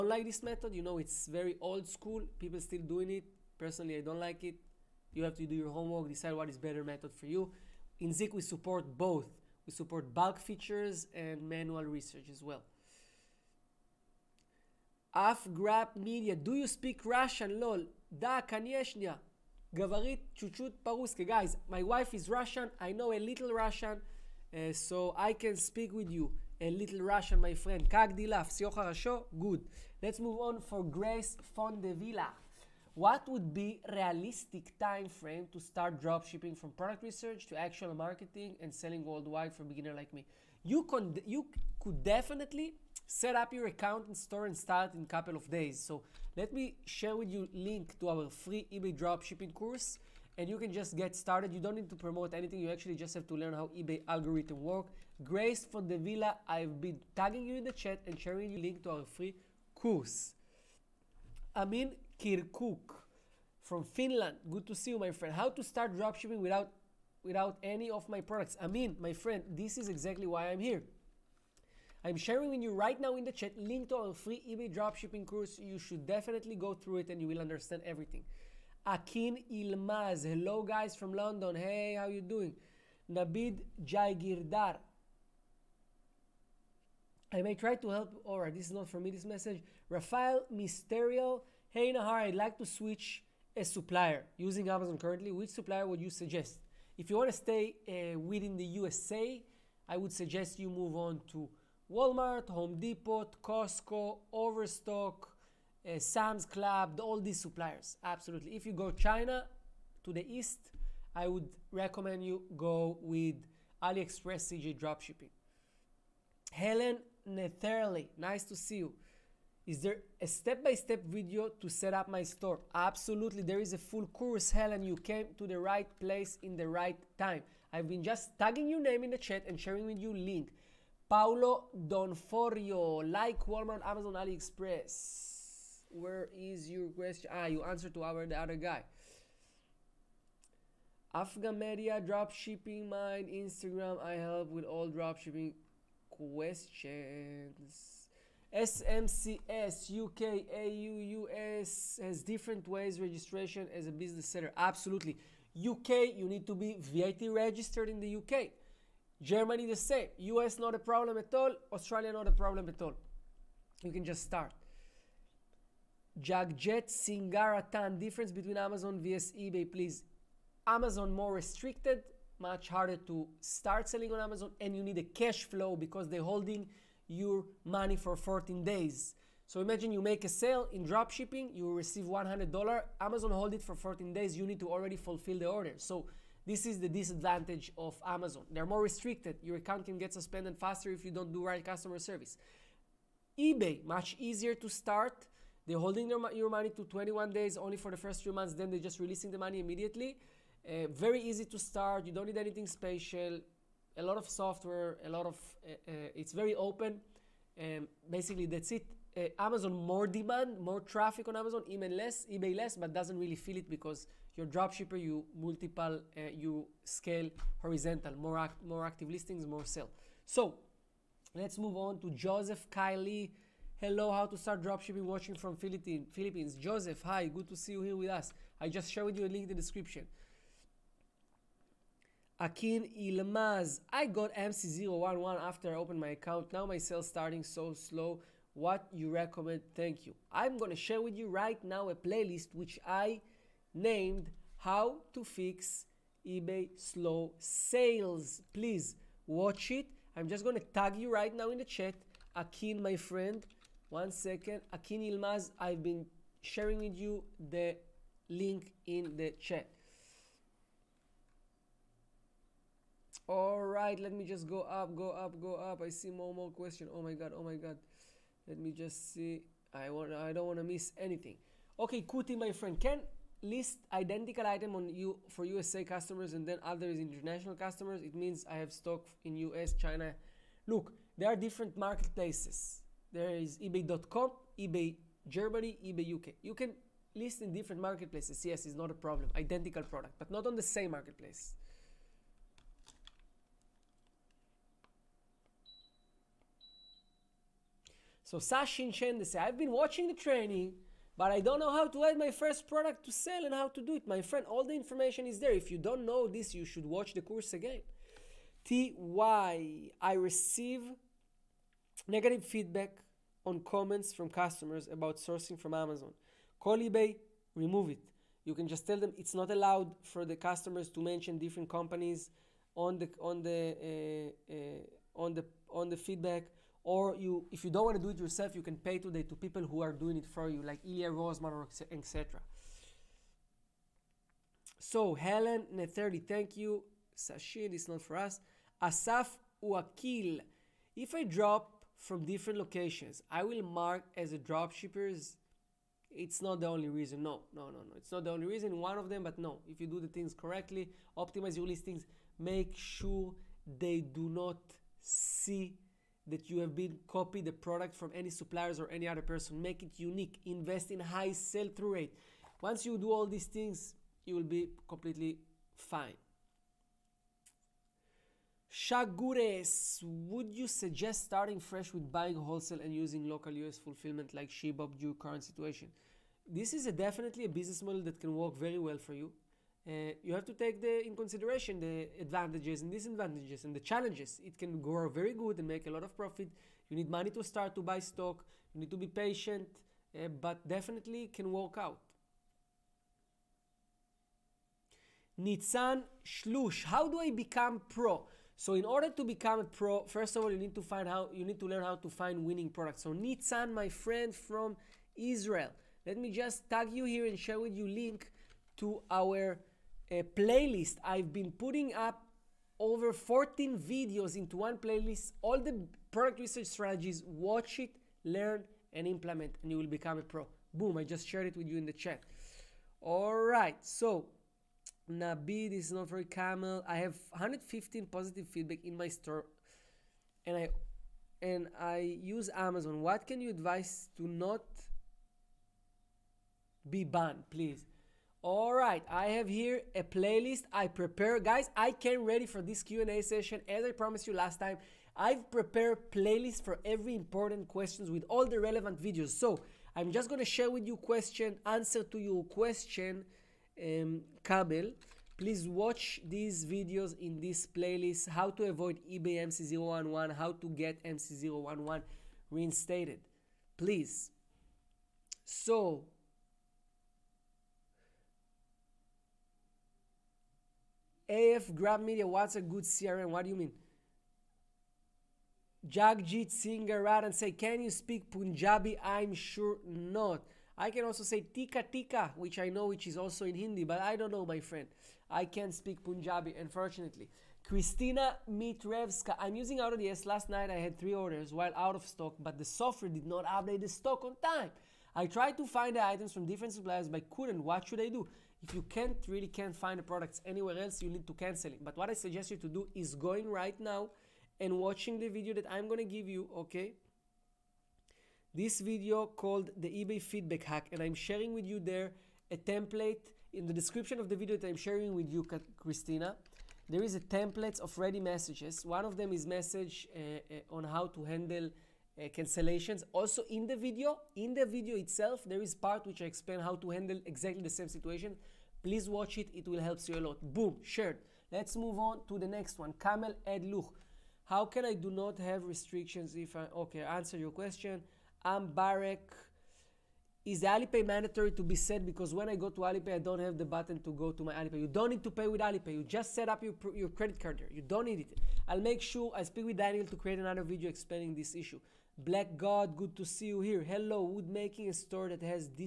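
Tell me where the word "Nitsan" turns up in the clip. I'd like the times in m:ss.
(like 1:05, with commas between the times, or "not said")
6:35, 6:43.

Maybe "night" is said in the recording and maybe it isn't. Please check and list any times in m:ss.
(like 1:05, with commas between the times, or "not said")
8:10.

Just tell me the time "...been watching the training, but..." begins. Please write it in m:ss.
4:59.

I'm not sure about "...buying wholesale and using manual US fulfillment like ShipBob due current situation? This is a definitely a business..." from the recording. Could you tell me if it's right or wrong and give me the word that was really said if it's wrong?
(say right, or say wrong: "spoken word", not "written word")
wrong: "local", not "manual".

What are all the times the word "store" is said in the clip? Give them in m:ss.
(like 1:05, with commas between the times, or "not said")
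0:44, 2:02, 7:09, 9:14.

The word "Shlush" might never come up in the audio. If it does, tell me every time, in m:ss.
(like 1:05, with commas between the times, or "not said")
6:36.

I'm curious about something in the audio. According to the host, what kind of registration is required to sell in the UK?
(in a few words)
VAT registered.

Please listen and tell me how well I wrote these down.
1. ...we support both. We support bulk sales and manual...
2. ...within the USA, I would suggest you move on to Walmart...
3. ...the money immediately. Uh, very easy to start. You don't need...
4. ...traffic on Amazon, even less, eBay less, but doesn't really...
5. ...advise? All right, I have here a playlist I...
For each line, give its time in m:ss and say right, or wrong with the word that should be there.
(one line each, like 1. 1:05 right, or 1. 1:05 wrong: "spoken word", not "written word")
1. 0:08 wrong: "features", not "sales"
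2. 1:38 right
3. 3:19 right
4. 3:30 right
5. 7:17 wrong: "please", not "advise".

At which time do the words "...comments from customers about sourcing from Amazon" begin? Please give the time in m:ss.
5:13.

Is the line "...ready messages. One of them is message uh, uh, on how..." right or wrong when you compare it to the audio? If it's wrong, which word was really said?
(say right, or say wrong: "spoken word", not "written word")
right.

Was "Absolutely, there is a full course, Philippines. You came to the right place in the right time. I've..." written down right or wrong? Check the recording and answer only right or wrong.
wrong.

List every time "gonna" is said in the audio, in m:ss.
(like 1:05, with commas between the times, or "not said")
4:00, 4:10, 8:25.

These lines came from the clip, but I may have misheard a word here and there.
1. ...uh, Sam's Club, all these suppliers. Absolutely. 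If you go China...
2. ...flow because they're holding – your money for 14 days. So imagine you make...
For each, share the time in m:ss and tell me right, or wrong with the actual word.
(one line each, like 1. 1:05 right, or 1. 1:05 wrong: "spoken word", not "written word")
1. 1:45 right
2. 2:55 right.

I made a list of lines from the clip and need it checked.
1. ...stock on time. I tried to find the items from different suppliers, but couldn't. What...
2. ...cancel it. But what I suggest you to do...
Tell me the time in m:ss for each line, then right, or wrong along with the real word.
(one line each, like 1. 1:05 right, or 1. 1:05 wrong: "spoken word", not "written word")
1. 8:13 right
2. 8:21 right.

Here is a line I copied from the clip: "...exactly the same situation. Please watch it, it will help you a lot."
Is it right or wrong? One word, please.
right.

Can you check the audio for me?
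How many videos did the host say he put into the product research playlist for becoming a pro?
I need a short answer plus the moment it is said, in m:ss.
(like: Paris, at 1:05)
14, at 6:53.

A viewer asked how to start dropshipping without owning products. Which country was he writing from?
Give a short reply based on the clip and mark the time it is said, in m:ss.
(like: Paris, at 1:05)
Finland, at 1:03.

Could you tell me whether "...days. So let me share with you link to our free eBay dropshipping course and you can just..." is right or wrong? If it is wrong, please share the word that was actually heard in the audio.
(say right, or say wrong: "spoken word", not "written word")
right.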